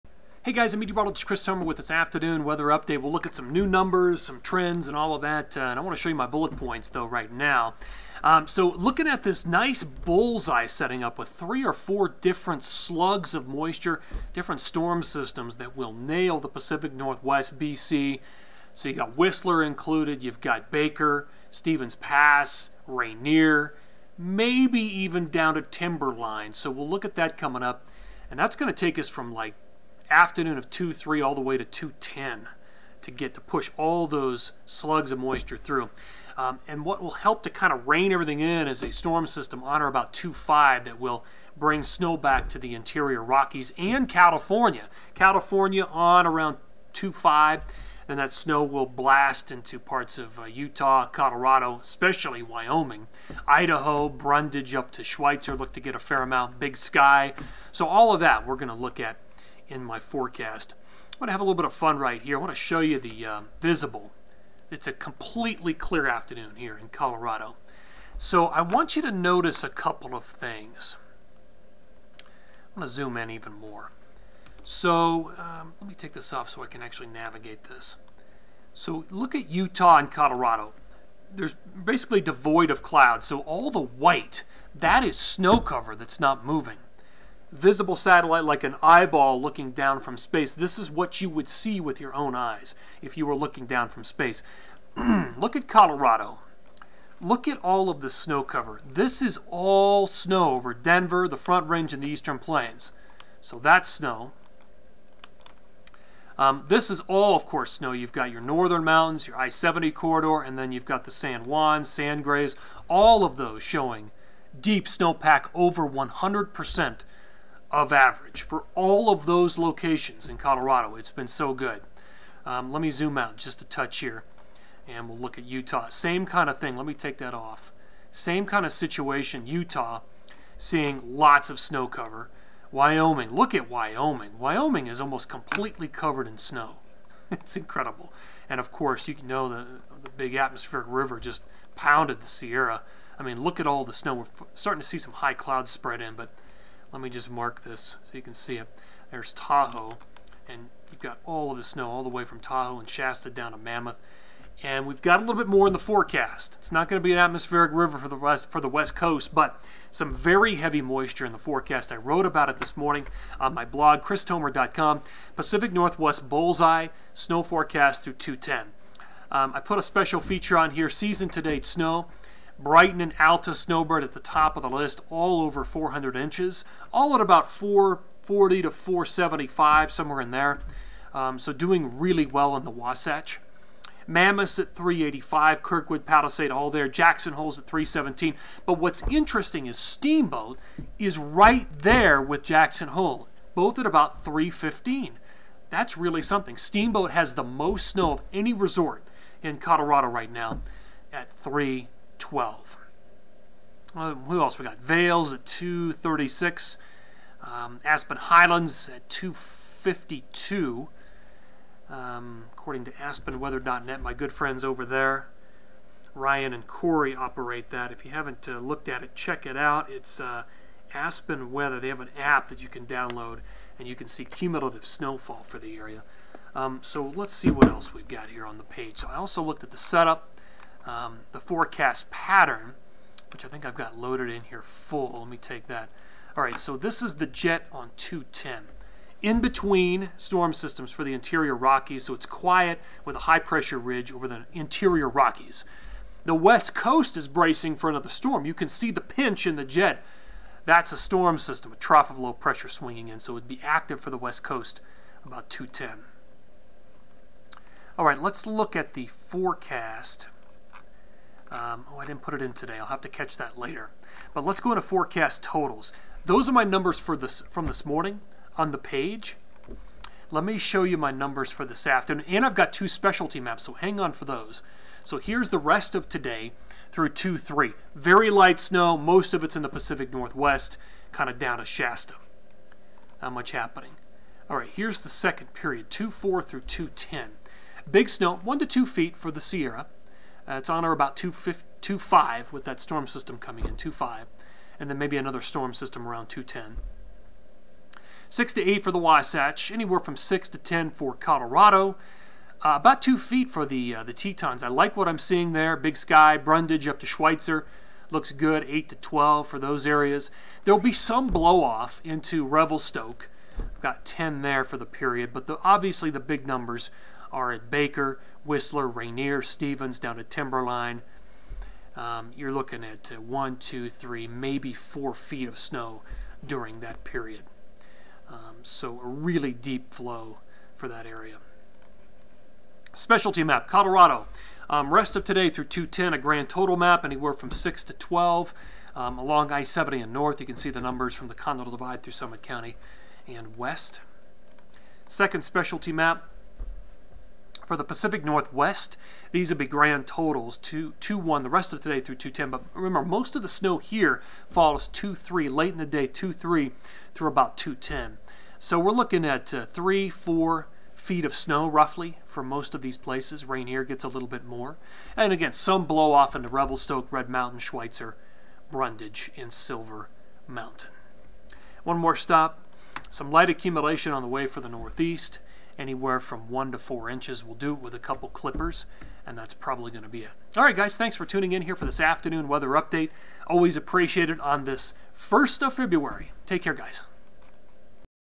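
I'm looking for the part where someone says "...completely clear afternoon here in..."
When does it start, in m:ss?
1:04.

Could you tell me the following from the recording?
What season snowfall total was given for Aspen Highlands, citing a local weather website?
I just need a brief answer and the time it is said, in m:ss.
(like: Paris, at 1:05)
252, at 3:27.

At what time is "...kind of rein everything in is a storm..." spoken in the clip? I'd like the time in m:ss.
0:37.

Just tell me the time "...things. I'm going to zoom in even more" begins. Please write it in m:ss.
1:10.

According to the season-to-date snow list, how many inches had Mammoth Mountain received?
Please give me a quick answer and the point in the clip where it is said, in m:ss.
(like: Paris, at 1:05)
385, at 3:04.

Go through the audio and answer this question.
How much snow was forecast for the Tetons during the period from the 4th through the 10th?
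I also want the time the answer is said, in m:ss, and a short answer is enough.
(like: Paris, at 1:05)
About 2 feet, at 5:02.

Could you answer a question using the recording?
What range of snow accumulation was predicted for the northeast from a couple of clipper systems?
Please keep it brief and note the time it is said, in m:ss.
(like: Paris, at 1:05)
1 to 4 inches, at 6:16.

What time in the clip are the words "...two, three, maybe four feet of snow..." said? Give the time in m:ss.
5:23.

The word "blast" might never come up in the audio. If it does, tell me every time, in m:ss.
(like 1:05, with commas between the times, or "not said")
0:48.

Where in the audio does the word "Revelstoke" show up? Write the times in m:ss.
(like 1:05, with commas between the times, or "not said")
5:12, 6:06.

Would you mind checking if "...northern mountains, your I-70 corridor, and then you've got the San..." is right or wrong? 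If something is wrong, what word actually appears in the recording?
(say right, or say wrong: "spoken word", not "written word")
right.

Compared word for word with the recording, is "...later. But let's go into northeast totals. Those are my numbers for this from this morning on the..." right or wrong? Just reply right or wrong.
wrong.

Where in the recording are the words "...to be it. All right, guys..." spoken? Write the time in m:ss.
6:20.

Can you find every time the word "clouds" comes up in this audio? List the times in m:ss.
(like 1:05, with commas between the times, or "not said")
1:22, 2:25.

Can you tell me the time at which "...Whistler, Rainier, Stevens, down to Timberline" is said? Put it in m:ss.
5:18.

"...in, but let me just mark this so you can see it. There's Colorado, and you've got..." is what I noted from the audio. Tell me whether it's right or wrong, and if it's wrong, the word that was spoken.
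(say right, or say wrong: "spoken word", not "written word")
wrong: "Tahoe", not "Colorado".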